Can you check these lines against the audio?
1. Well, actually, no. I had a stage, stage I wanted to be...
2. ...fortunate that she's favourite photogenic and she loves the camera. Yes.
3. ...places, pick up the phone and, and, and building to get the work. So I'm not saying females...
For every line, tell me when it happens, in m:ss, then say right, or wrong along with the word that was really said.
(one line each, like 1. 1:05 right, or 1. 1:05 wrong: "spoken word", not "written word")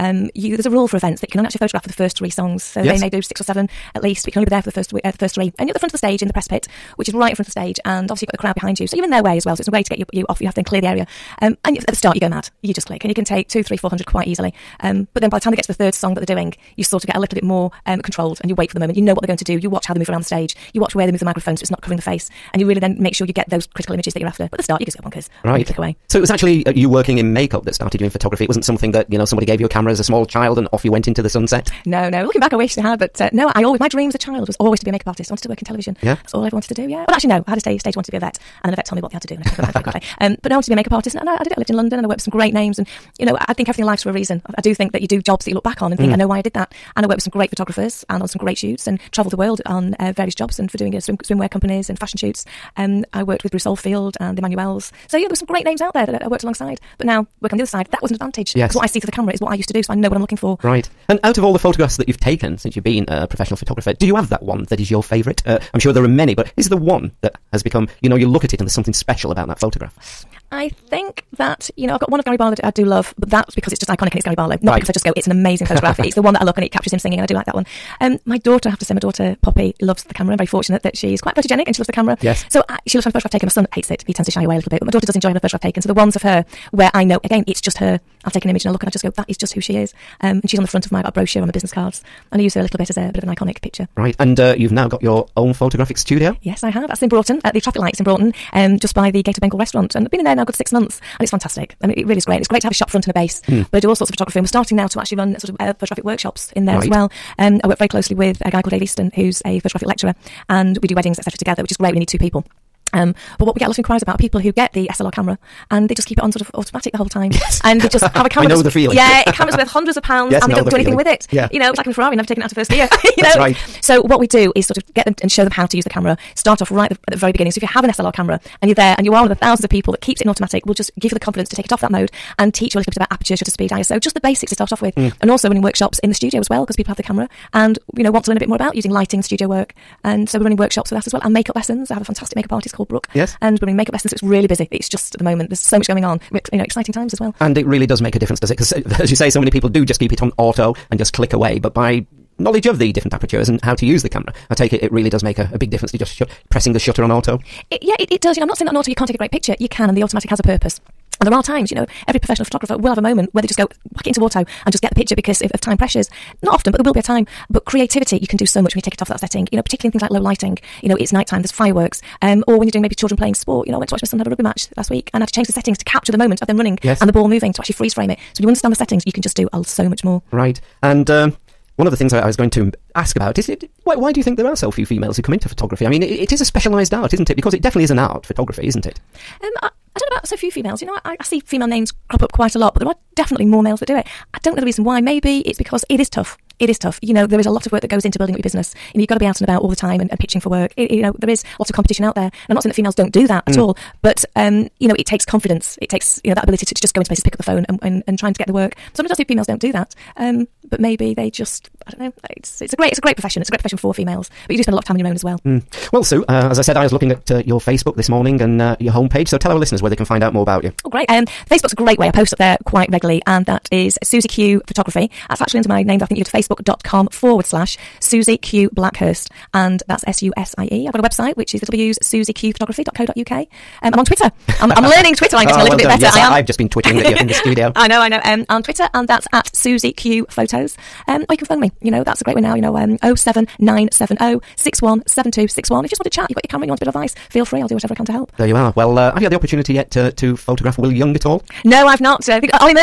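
1. 0:37 right
2. 1:20 wrong: "quite", not "favourite"
3. 3:27 wrong: "trying", not "building".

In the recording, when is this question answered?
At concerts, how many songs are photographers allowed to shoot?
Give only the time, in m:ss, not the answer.
0:01.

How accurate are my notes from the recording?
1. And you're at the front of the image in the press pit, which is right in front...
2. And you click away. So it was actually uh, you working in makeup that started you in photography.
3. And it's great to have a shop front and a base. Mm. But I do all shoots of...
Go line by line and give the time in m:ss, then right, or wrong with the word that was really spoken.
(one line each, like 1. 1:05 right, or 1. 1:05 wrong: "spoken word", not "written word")
1. 0:05 wrong: "stage", not "image"
2. 0:25 right
3. 1:42 wrong: "sorts", not "shoots".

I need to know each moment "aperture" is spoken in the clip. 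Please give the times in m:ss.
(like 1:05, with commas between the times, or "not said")
2:13, 2:33.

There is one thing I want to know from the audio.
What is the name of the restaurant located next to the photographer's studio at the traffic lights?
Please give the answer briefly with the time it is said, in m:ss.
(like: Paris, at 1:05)
Gate of Bengal, at 1:39.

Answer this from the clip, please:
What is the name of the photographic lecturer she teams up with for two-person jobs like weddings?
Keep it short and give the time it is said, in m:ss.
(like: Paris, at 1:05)
Dave Easton, at 1:48.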